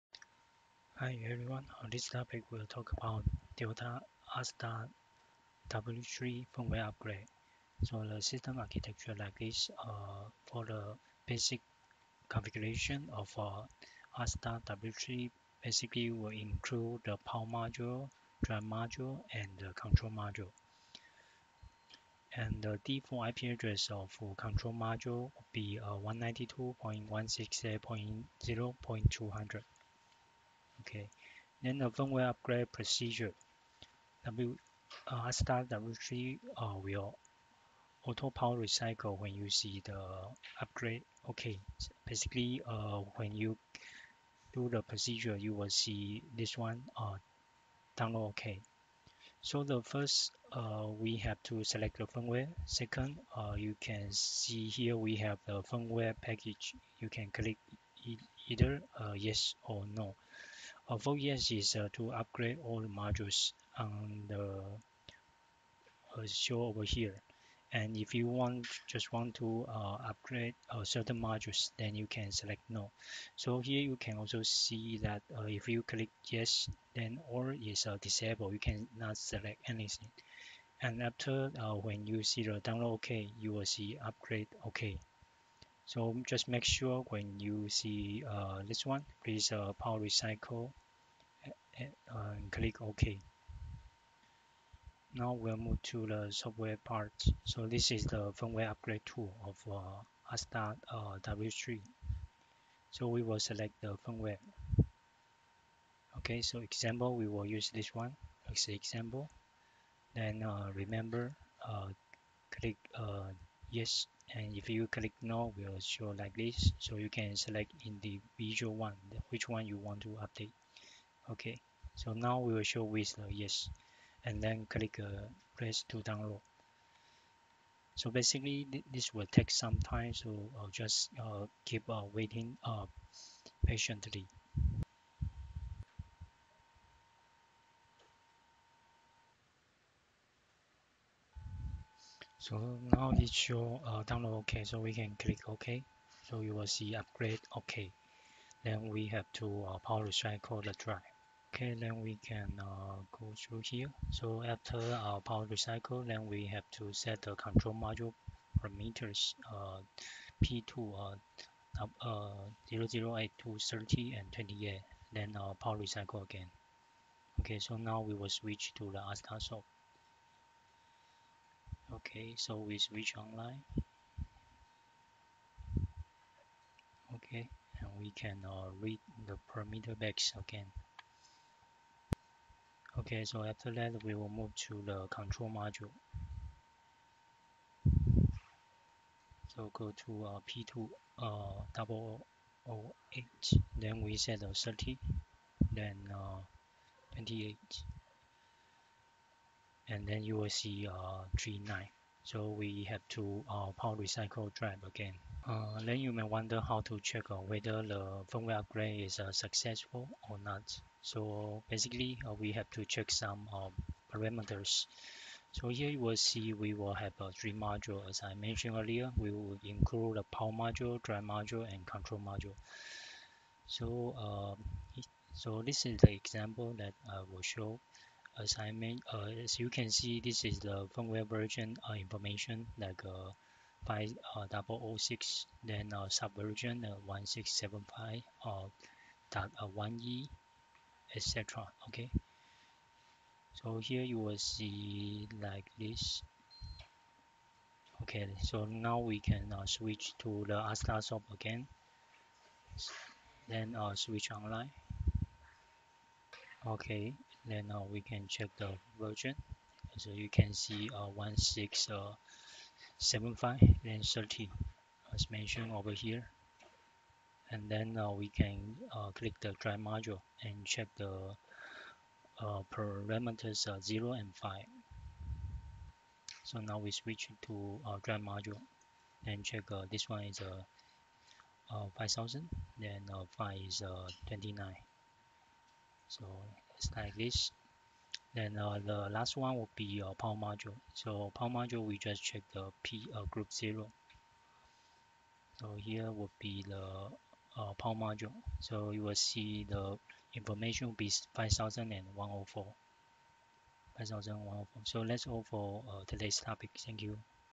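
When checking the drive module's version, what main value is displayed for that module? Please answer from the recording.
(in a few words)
5000.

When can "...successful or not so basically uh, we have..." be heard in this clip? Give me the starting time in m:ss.
3:29.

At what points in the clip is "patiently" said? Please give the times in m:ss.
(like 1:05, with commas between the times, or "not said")
2:13.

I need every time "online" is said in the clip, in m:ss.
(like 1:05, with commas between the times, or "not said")
2:53, 4:14.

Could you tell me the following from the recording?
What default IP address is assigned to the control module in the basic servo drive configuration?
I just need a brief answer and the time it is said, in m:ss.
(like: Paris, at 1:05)
192.168.0.200, at 0:25.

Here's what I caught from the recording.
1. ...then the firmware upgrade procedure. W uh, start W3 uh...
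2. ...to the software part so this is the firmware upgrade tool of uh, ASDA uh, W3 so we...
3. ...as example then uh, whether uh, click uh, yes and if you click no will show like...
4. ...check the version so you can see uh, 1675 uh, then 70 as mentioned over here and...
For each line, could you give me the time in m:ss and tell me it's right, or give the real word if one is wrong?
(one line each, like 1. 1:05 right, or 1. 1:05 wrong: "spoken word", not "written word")
1. 0:31 right
2. 1:35 right
3. 1:48 wrong: "remember", not "whether"
4. 4:18 wrong: "30", not "70".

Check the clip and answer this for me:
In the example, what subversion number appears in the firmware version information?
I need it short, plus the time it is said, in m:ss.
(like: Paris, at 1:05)
1675.1e, at 3:56.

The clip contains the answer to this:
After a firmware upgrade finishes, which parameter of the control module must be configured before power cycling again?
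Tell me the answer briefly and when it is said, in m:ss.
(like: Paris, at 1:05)
P2-008, at 2:40.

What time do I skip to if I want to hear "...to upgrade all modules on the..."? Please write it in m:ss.
1:01.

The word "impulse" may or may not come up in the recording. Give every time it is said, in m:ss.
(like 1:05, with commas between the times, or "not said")
not said.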